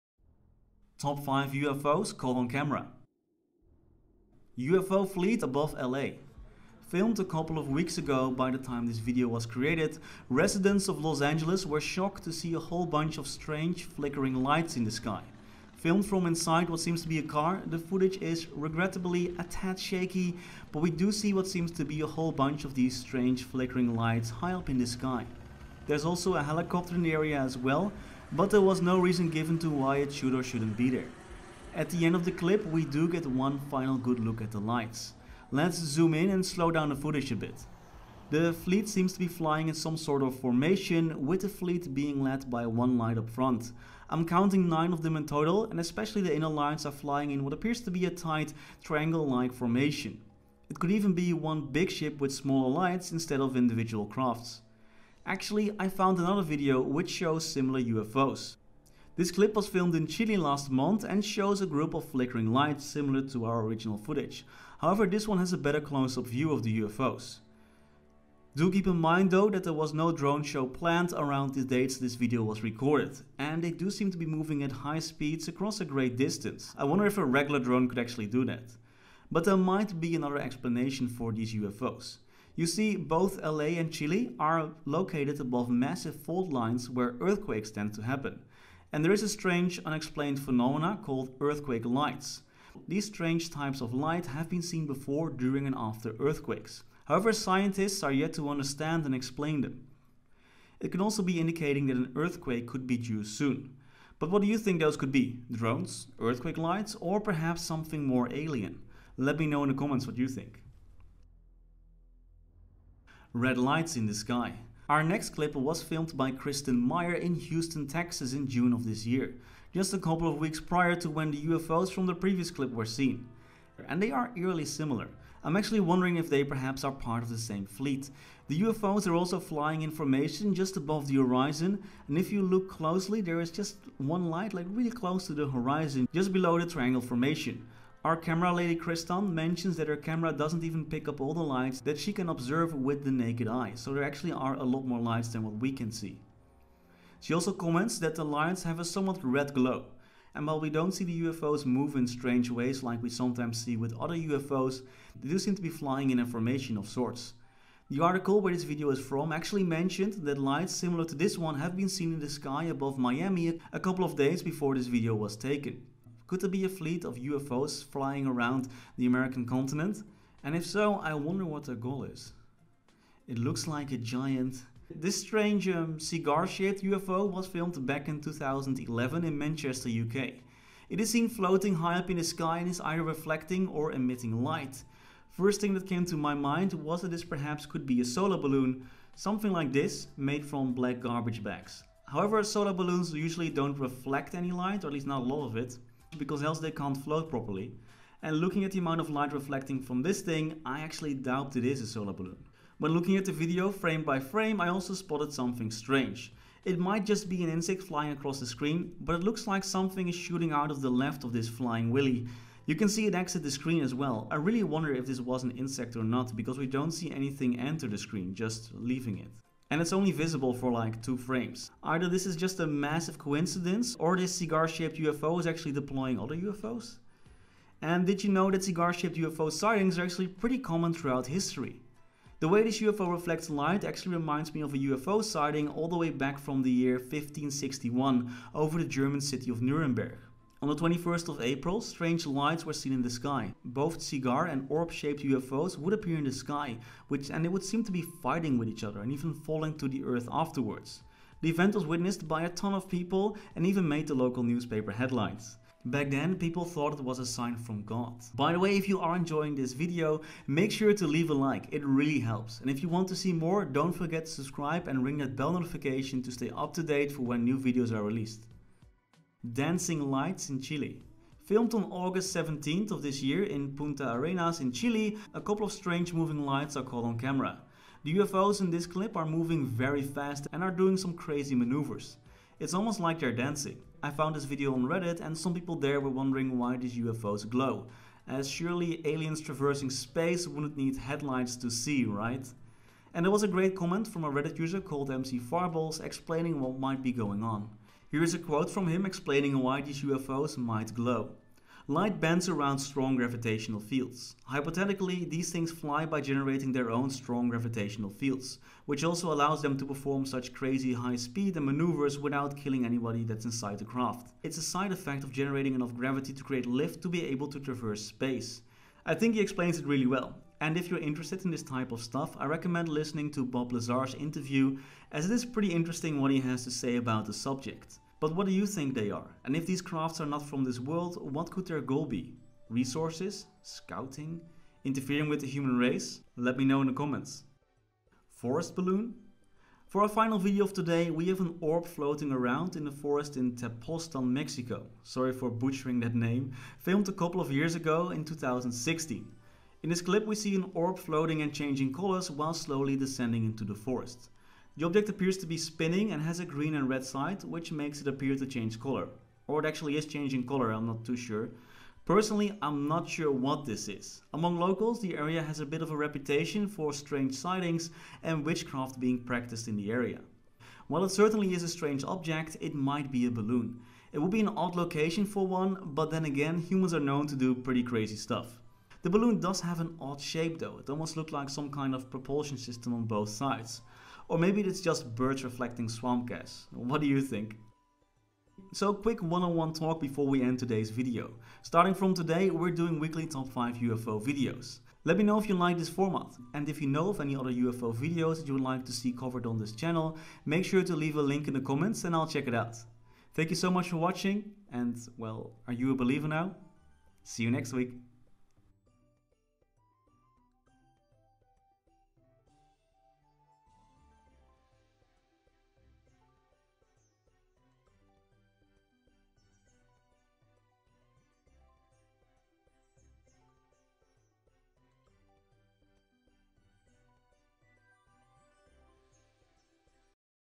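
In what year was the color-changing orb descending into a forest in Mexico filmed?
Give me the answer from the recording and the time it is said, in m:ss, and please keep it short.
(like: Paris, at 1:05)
2016, at 5:48.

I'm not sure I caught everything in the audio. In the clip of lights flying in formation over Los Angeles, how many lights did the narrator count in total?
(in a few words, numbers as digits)
9.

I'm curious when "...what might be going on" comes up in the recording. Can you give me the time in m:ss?
4:56.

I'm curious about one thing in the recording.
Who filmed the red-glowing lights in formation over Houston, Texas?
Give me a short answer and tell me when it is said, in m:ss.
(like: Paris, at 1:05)
Kristen Meyer, at 1:56.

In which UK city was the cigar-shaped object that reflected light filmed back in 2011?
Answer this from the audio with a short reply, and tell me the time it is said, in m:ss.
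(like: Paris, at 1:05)
Manchester, at 2:59.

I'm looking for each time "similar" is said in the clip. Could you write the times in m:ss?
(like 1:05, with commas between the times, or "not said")
0:57, 1:02, 2:04, 2:40.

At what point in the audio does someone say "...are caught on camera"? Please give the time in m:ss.
4:36.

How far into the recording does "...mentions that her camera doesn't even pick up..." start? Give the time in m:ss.
2:19.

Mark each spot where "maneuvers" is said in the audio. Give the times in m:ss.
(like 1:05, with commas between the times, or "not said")
4:41, 5:11.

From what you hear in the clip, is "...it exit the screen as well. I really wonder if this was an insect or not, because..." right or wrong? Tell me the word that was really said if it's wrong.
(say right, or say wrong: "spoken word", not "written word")
right.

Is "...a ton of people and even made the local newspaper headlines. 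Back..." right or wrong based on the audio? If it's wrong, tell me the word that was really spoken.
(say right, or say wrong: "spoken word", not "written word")
right.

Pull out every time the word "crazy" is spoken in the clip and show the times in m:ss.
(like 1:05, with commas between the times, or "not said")
4:41, 5:10, 6:17.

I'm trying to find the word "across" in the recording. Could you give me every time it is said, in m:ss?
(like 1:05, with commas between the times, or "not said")
1:15, 3:28.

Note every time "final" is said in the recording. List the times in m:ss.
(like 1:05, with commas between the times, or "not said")
0:33, 5:40.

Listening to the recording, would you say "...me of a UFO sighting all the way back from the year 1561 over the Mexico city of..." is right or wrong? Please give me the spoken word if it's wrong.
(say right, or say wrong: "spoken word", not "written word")
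wrong: "German", not "Mexico".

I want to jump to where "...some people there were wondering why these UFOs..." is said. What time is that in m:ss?
4:45.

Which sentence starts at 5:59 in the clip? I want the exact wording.
Or it actually is changing color, I'm not too sure.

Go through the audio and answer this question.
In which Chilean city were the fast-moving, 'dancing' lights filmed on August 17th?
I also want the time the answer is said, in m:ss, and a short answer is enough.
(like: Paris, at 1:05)
Punta Arenas, at 4:33.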